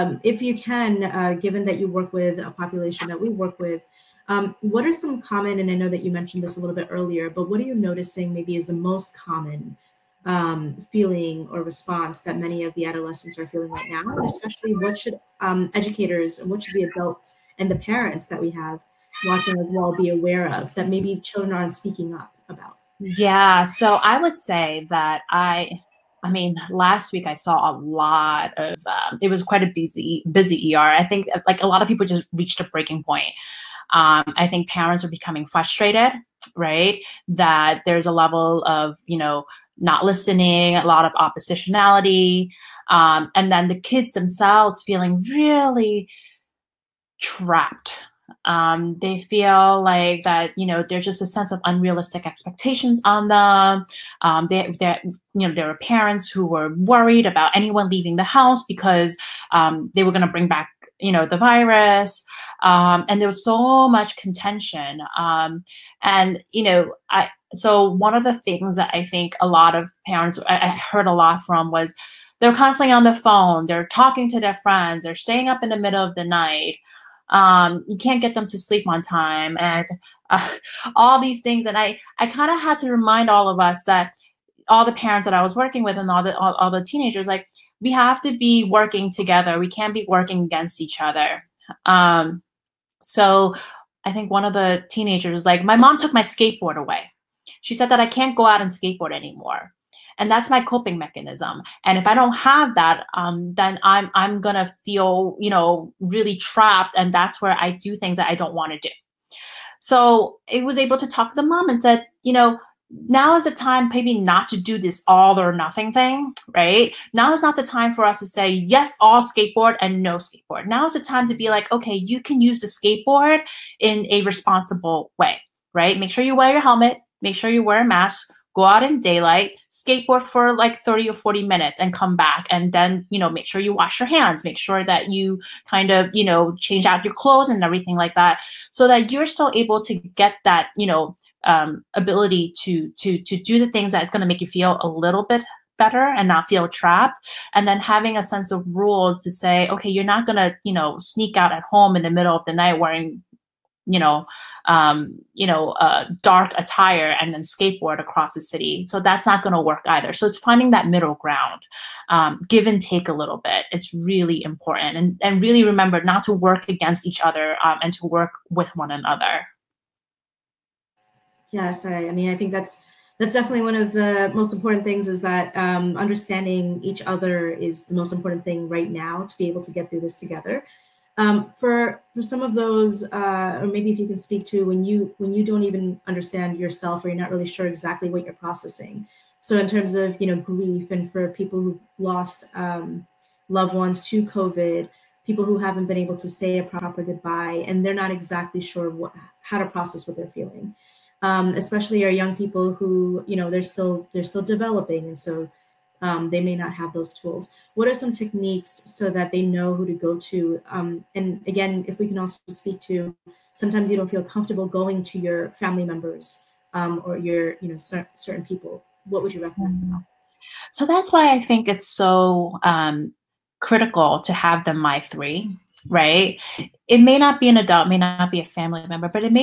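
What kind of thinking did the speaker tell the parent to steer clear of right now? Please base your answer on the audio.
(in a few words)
All or nothing.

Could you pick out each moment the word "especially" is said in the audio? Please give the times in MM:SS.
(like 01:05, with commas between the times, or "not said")
00:14, 03:21.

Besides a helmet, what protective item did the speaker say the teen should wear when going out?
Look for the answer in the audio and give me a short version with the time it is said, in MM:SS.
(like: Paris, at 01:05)
Mask, at 02:07.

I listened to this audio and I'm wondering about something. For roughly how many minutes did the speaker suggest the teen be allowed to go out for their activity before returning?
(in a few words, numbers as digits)
30 or 40 minutes.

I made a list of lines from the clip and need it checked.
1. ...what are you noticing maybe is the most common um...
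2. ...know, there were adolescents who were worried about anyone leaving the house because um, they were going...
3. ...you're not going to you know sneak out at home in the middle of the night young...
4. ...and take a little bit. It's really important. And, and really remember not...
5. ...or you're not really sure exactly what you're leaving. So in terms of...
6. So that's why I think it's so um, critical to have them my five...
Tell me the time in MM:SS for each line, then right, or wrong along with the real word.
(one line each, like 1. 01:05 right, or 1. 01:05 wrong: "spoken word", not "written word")
1. 00:07 right
2. 00:55 wrong: "parents", not "adolescents"
3. 02:29 wrong: "wearing", not "young"
4. 02:42 right
5. 03:07 wrong: "processing", not "leaving"
6. 03:40 wrong: "three", not "five".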